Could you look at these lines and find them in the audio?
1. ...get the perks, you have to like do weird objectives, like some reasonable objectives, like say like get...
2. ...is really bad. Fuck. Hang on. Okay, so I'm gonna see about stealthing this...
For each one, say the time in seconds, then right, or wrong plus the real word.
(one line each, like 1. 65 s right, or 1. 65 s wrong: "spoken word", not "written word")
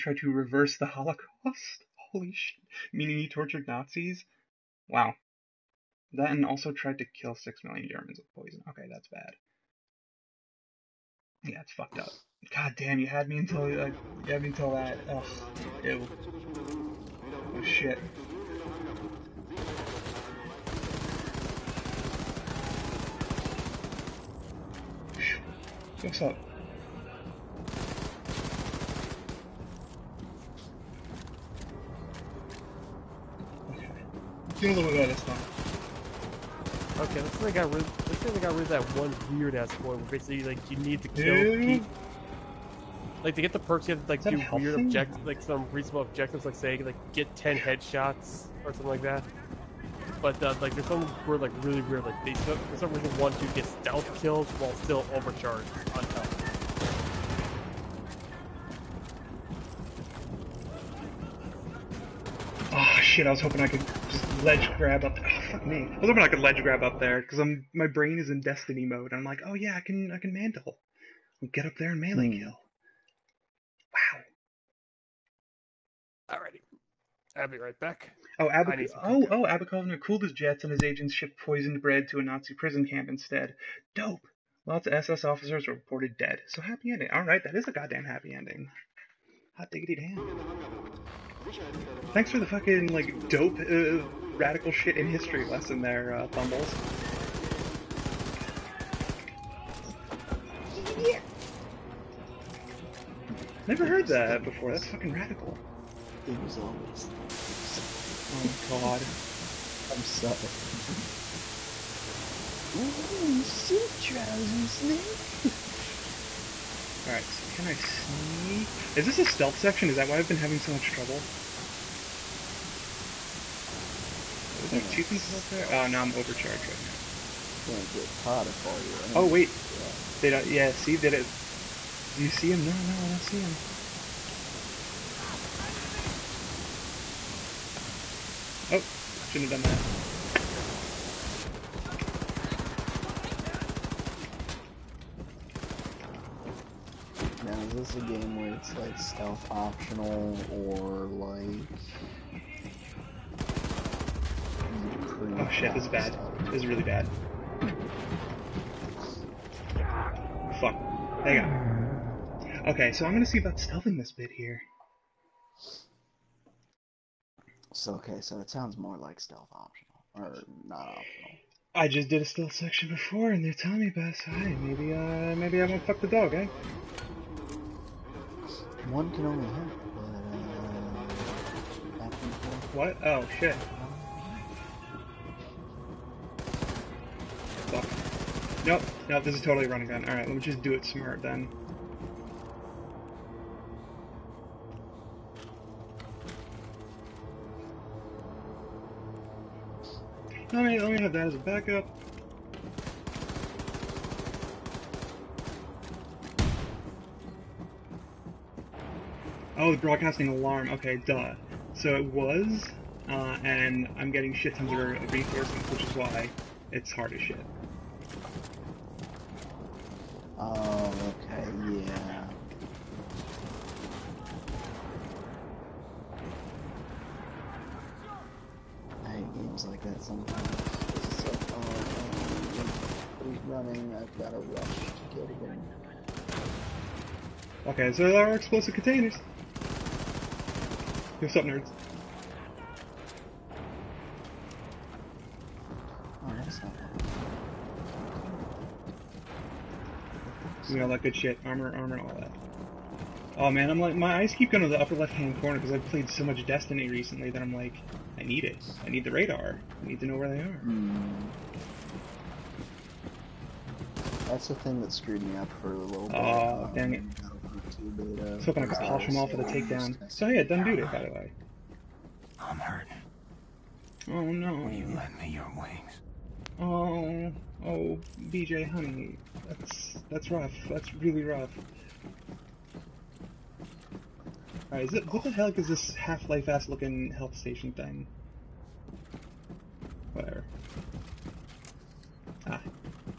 1. 43 s right
2. 156 s right.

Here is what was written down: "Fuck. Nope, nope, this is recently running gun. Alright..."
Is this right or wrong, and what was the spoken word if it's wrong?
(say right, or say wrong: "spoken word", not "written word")
wrong: "totally", not "recently".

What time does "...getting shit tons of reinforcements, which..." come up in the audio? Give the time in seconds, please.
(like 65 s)
214 s.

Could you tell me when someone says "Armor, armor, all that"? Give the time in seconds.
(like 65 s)
251 s.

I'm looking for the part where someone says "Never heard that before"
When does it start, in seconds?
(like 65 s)
103 s.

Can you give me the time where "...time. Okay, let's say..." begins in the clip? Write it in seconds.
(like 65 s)
35 s.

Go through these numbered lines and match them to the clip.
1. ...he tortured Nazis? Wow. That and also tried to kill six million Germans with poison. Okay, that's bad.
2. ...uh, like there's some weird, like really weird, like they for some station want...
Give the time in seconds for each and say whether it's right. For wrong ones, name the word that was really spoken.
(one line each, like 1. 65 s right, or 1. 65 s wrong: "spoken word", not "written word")
1. 3 s right
2. 50 s wrong: "reason", not "station".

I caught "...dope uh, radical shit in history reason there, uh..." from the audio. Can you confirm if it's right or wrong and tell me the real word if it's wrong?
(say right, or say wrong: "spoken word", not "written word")
wrong: "lesson", not "reason".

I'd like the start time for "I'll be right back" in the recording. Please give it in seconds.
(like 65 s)
77 s.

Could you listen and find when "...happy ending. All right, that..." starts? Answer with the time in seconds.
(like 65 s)
86 s.